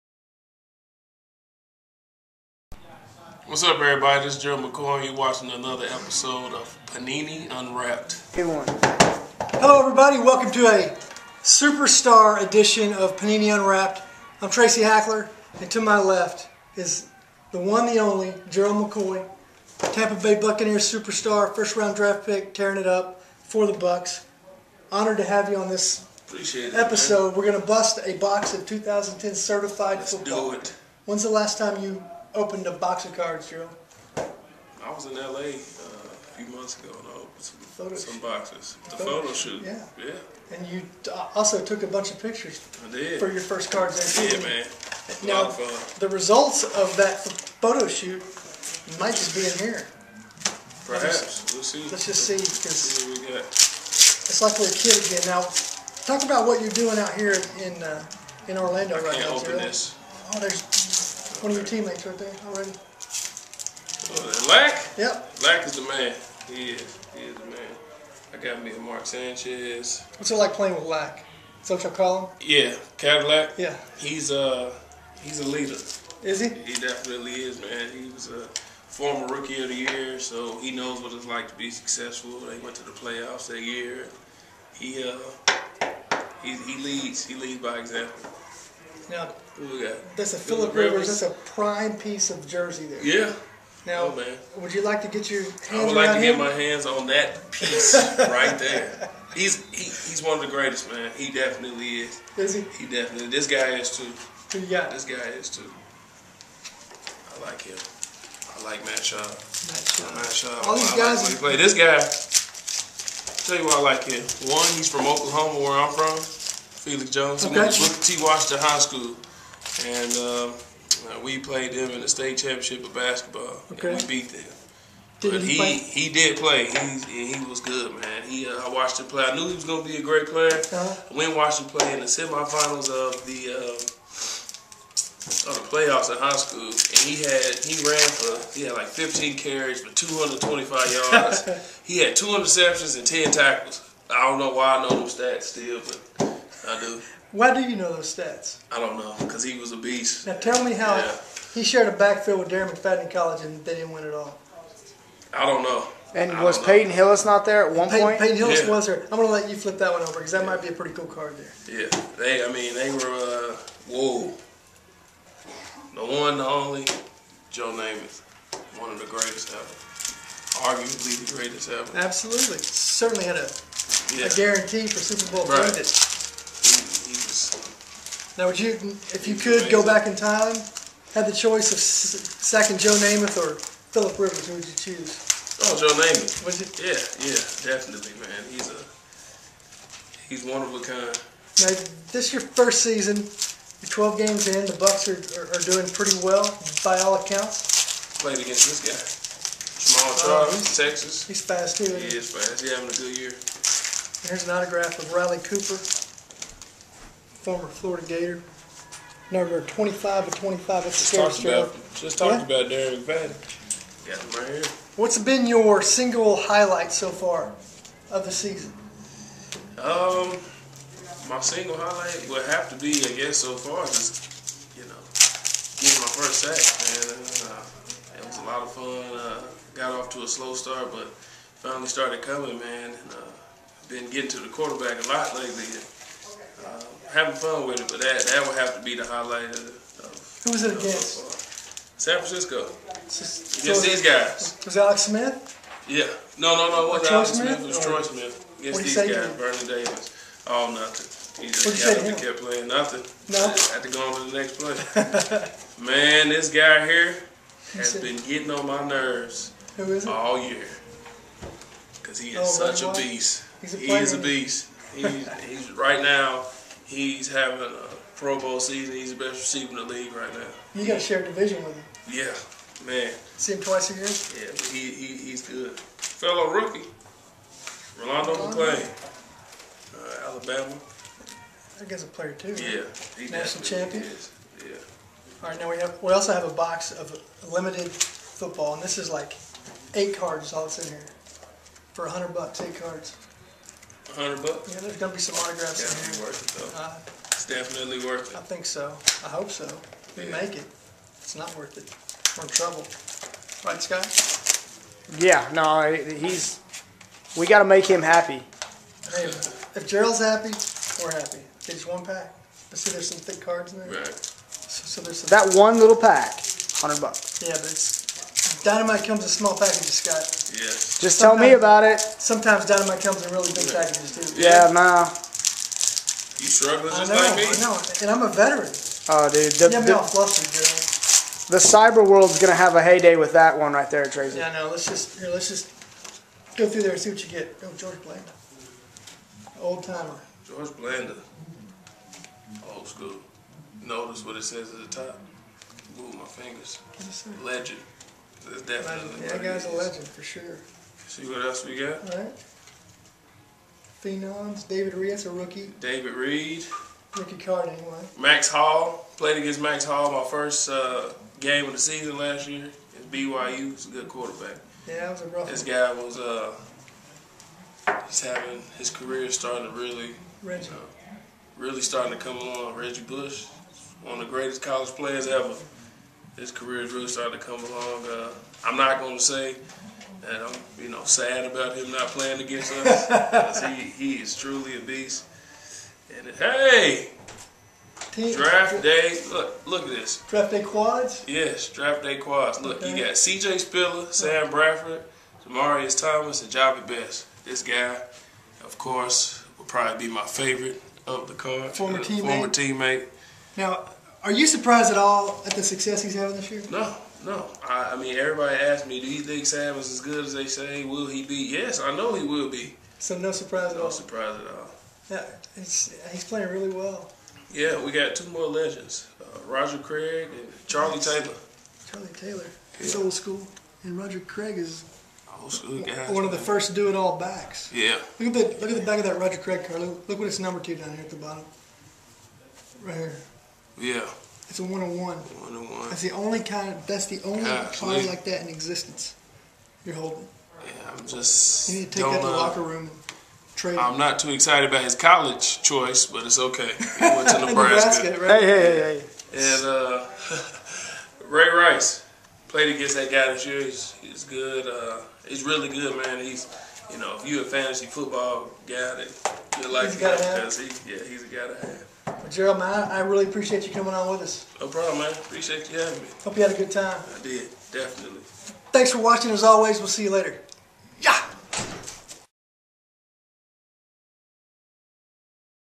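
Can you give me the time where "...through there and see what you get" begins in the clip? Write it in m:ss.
5:36.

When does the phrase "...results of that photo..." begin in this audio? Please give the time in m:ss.
0:46.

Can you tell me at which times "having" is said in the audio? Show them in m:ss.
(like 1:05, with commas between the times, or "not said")
3:22, 3:57, 4:27, 6:08, 6:46, 7:45.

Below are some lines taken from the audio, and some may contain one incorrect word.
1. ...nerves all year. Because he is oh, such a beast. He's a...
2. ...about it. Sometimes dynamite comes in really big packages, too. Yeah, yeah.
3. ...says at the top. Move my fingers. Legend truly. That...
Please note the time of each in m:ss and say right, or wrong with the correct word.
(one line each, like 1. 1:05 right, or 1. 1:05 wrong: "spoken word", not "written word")
1. 4:18 right
2. 5:21 right
3. 5:44 wrong: "definitely", not "truly".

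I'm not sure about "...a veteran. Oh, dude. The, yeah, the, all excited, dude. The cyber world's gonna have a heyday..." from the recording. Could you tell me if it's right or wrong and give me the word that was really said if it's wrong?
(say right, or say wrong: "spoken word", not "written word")
wrong: "flustered", not "excited".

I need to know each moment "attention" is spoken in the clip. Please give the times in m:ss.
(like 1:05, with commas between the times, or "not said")
not said.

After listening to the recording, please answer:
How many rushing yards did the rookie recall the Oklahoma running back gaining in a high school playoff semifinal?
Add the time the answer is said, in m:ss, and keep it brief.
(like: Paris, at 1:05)
225, at 2:19.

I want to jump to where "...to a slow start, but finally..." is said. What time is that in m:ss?
3:50.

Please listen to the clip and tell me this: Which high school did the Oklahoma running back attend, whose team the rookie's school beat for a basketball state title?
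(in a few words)
T. Washington High School.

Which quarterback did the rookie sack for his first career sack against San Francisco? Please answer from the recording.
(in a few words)
Troy Smith.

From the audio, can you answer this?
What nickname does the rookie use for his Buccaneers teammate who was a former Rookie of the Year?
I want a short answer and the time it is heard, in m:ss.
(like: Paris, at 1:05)
Cadillac, at 1:12.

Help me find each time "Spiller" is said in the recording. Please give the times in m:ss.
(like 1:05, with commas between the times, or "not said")
6:33.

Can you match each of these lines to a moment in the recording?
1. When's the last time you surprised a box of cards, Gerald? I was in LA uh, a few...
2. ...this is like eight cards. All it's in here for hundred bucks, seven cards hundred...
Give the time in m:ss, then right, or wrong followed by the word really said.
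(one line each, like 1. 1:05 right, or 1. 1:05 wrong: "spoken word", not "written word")
1. 0:31 wrong: "opened", not "surprised"
2. 4:48 wrong: "eight", not "seven".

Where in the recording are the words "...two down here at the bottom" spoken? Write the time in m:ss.
7:10.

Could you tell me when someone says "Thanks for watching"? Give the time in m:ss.
7:48.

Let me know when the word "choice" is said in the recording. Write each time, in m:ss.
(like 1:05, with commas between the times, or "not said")
3:01, 7:25.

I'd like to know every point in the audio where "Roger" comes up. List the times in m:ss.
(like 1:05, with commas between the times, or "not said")
6:59, 7:03, 7:09.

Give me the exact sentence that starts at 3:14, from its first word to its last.
The Bucs are, are, are doing pretty well by all accounts.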